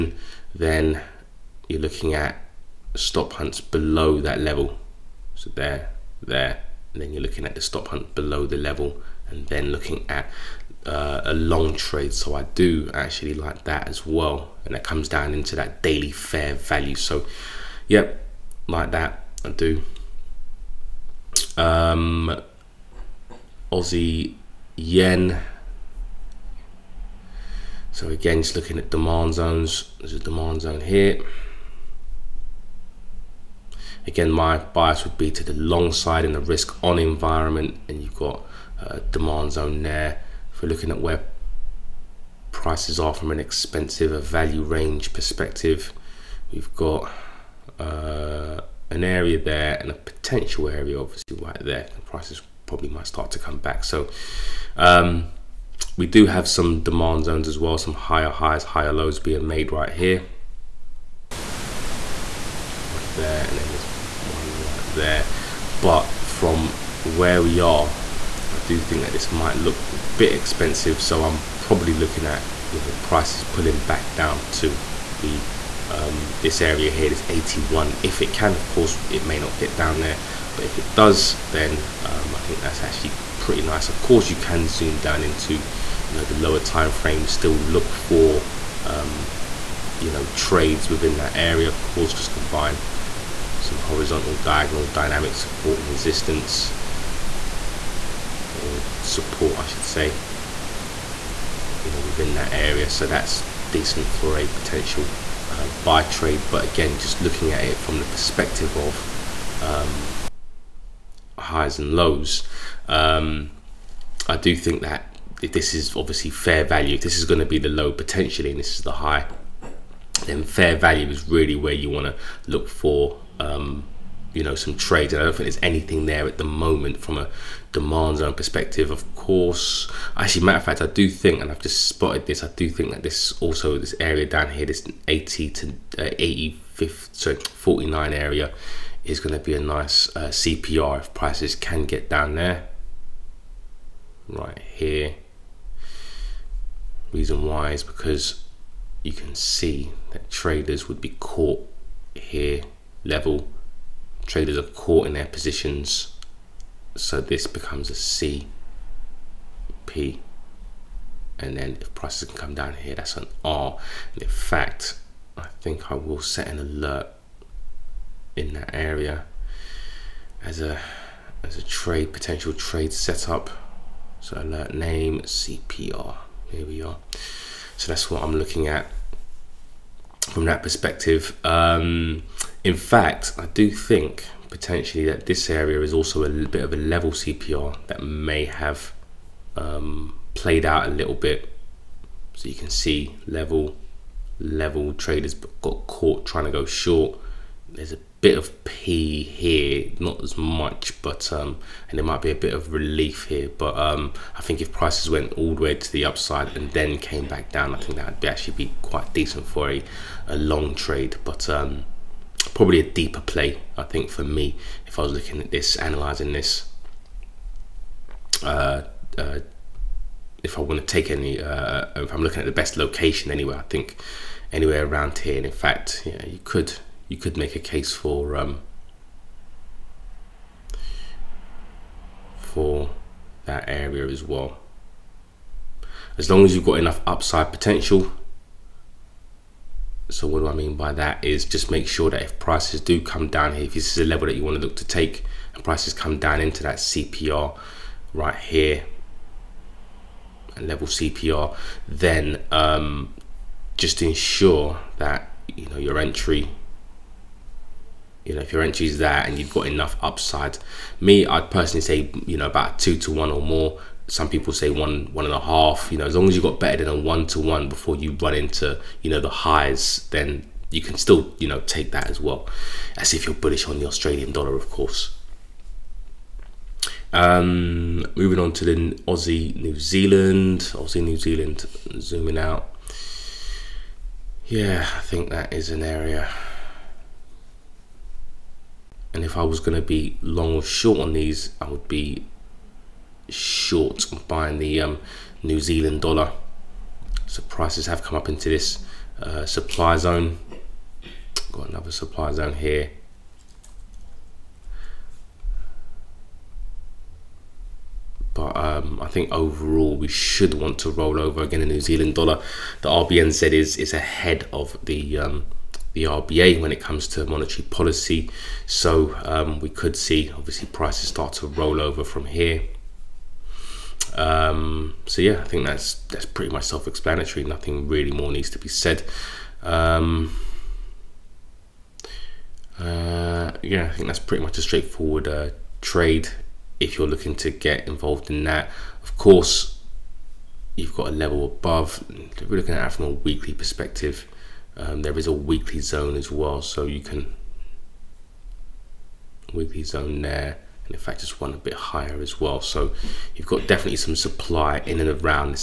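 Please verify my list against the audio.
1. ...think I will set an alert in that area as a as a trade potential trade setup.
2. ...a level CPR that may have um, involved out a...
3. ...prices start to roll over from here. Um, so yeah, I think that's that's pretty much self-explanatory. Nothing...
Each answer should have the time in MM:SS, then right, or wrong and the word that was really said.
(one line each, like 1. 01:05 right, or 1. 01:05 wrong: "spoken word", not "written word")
1. 02:45 right
2. 03:06 wrong: "played", not "involved"
3. 05:20 right.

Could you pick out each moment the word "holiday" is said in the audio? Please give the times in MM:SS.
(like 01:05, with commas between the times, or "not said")
not said.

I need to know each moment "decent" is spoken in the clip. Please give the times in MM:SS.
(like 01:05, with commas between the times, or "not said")
01:43, 03:29.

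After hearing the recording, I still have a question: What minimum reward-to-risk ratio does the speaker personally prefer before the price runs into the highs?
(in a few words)
2 to 1.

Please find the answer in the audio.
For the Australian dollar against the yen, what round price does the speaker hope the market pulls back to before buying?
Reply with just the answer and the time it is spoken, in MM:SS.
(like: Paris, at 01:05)
81, at 01:17.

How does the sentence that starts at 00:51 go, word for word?
The prices probably might start to come back.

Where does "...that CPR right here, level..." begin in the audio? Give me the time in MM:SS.
04:06.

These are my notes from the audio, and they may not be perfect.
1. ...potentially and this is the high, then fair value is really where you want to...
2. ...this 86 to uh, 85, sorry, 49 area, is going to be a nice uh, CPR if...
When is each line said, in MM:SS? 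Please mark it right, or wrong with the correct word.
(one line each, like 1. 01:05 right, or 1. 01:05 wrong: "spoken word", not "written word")
1. 01:57 right
2. 02:14 wrong: "80", not "86".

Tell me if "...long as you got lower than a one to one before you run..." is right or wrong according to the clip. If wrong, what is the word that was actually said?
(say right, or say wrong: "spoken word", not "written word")
wrong: "better", not "lower".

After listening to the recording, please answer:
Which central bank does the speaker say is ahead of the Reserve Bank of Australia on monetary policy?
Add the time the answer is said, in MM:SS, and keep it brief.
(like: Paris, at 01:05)
RBNZ, at 05:12.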